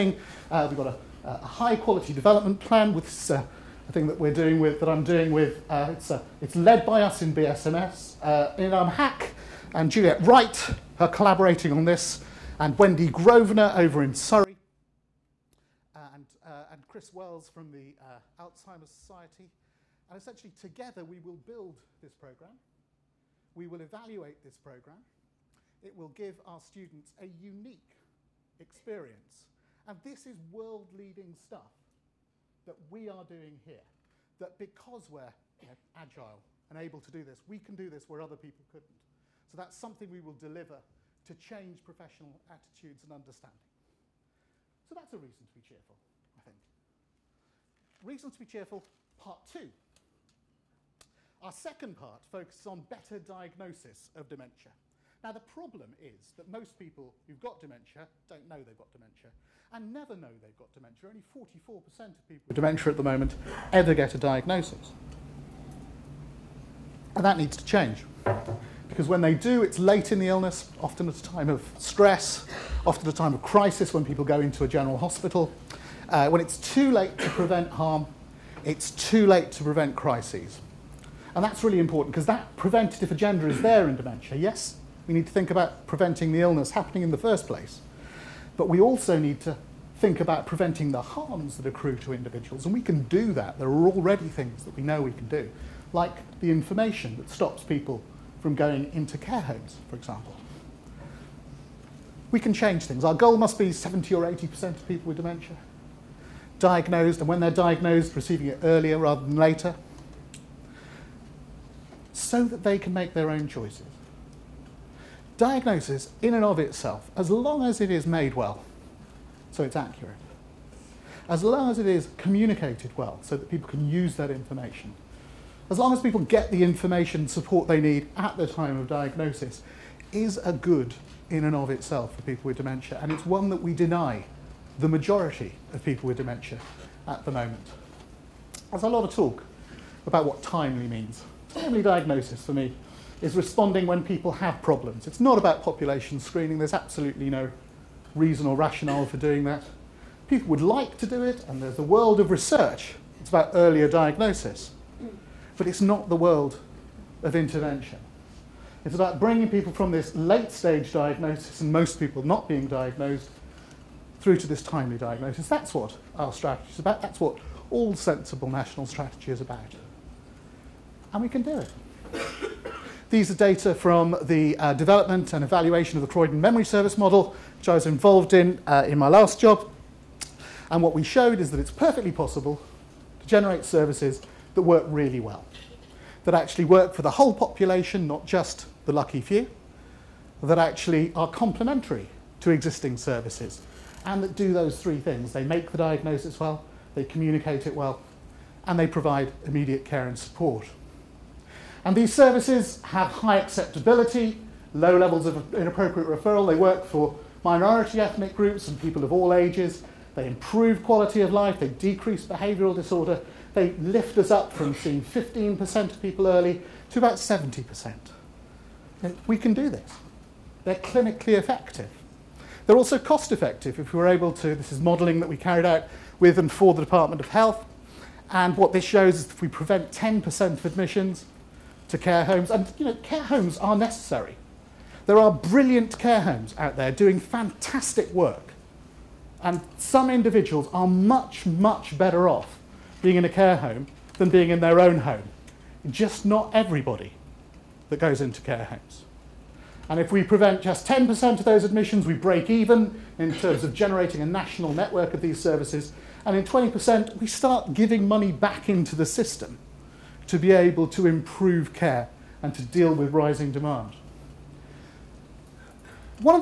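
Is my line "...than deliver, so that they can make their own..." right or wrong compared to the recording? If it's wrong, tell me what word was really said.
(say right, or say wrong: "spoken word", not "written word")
wrong: "later", not "deliver".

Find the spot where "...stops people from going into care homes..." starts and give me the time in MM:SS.
01:37.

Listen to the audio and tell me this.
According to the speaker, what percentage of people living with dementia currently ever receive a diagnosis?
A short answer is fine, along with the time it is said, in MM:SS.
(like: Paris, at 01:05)
44%, at 01:01.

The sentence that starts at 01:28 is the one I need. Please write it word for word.
But we also need to think about preventing the harms that accrue to individuals, and we can do that.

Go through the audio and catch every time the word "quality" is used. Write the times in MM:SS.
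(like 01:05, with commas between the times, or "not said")
00:01, 03:30.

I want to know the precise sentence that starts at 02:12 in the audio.
And it's one that we deny the majority of people with dementia at the moment.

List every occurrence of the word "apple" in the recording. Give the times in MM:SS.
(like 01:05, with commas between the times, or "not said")
not said.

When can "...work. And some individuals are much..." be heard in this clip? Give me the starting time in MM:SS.
03:58.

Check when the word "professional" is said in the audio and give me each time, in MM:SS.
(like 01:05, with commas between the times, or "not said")
00:41.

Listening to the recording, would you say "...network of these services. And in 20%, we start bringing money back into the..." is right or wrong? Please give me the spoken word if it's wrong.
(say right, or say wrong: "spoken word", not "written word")
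wrong: "giving", not "bringing".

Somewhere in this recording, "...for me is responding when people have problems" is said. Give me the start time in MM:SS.
02:22.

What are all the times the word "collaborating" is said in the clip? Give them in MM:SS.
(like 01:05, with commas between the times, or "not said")
00:11.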